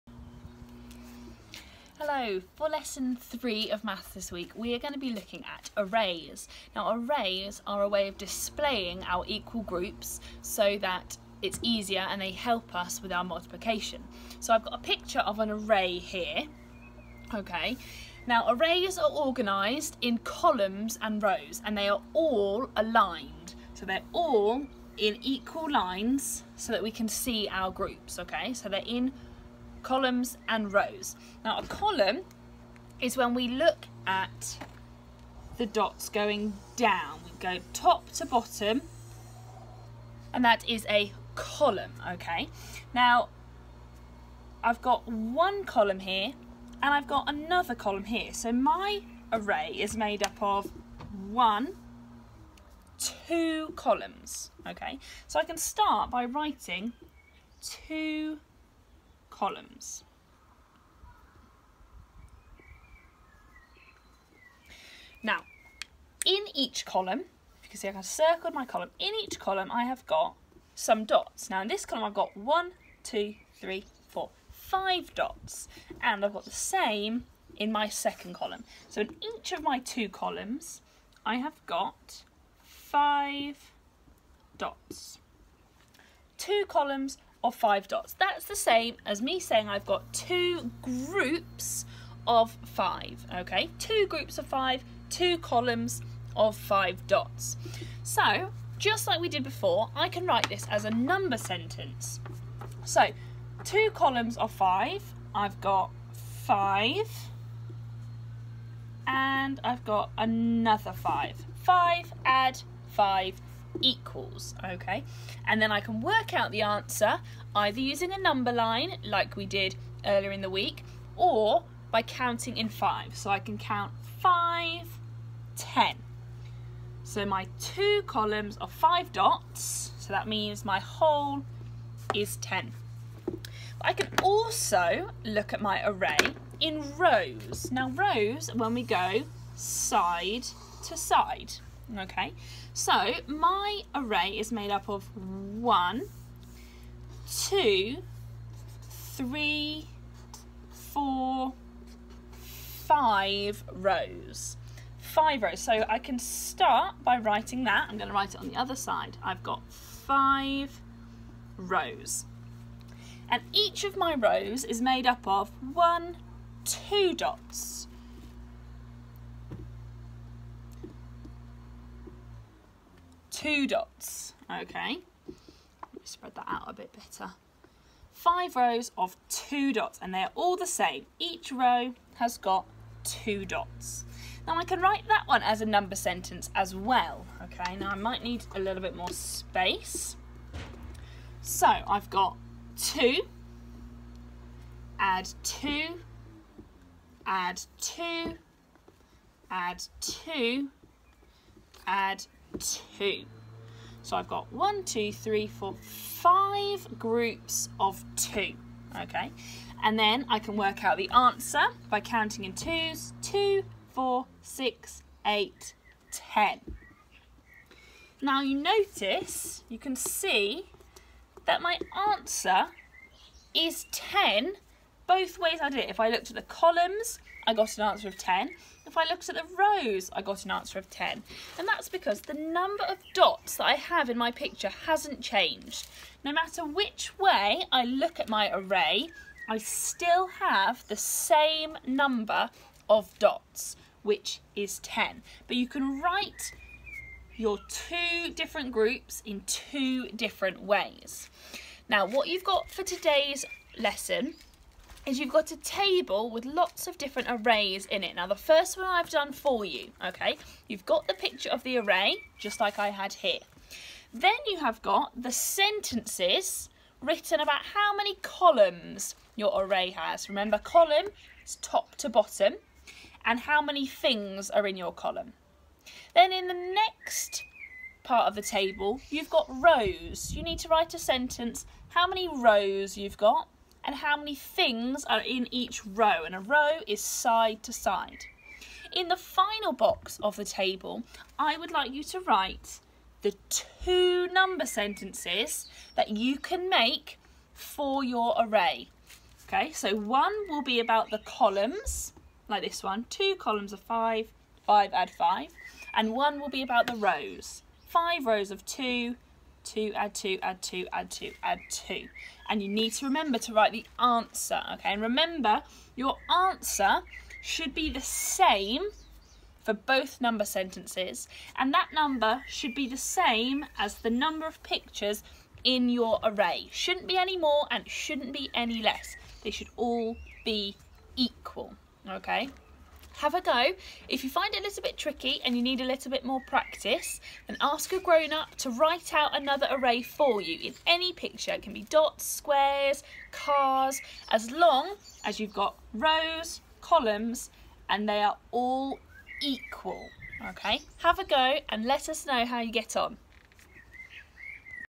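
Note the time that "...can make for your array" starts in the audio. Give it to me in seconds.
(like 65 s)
296 s.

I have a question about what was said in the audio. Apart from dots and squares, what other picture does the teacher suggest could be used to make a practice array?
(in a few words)
cars.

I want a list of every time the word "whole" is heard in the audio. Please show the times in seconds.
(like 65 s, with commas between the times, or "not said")
130 s.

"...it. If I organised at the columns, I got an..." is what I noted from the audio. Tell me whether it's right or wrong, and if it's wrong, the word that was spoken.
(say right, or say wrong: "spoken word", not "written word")
wrong: "looked", not "organised".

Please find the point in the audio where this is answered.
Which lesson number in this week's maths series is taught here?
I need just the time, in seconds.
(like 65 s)
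2 s.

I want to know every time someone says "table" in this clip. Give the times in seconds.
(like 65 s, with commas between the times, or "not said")
255 s, 278 s, 290 s.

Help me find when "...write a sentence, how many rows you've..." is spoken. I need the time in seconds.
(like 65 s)
280 s.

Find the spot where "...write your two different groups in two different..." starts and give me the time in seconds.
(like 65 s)
246 s.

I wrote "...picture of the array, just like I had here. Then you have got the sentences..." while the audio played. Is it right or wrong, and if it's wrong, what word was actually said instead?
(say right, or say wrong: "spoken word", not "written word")
right.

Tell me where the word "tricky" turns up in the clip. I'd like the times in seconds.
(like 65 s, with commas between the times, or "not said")
334 s.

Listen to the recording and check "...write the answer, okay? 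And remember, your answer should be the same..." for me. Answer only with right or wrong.
right.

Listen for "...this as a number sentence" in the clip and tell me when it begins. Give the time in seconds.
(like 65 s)
100 s.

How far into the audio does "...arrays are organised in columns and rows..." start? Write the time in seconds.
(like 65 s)
18 s.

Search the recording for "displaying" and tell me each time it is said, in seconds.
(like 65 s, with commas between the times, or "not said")
8 s.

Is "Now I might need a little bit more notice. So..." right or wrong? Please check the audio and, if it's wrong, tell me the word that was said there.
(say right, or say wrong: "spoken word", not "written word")
wrong: "space", not "notice".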